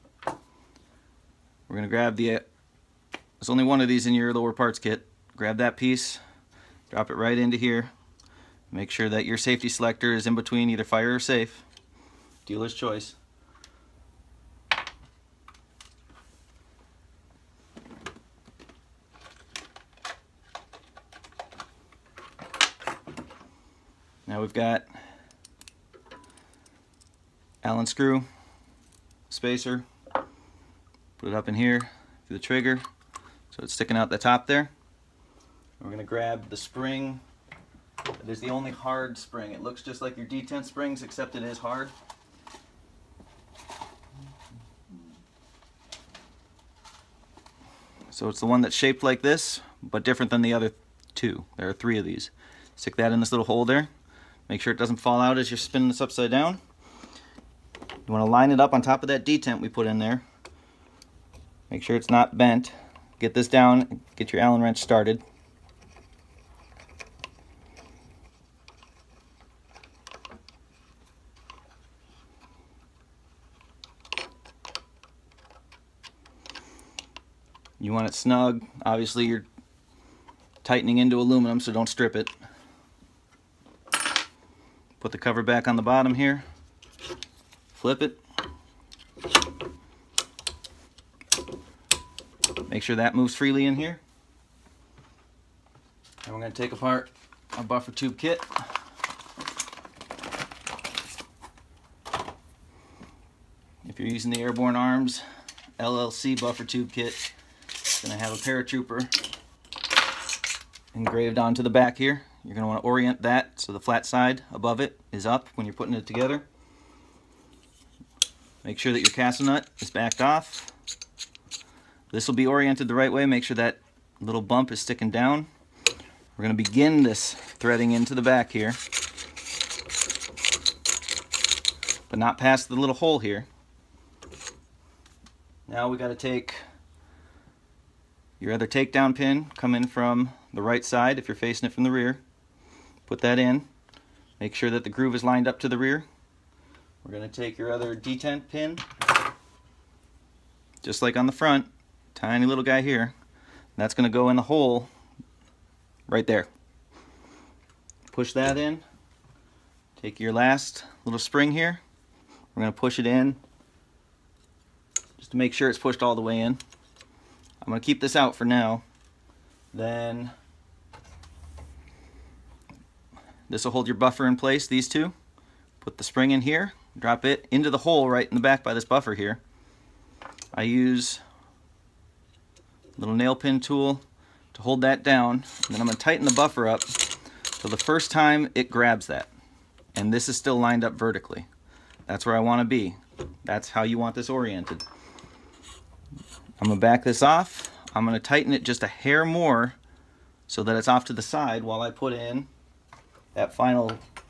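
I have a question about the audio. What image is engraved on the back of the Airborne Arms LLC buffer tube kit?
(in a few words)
a paratrooper.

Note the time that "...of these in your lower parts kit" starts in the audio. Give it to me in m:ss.
0:03.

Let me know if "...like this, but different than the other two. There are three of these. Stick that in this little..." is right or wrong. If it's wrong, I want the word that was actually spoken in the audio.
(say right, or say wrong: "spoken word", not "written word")
right.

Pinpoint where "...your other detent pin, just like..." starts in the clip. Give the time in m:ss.
2:27.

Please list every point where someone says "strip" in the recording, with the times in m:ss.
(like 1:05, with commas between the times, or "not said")
1:21.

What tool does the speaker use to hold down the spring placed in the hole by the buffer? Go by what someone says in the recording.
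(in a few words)
nail pin tool.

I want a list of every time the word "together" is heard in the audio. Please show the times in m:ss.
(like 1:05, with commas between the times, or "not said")
1:56.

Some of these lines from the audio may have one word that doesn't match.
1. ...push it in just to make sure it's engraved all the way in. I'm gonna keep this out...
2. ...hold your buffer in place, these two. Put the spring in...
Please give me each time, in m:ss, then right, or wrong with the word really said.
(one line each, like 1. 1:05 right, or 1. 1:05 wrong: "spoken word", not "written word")
1. 2:42 wrong: "pushed", not "engraved"
2. 2:53 right.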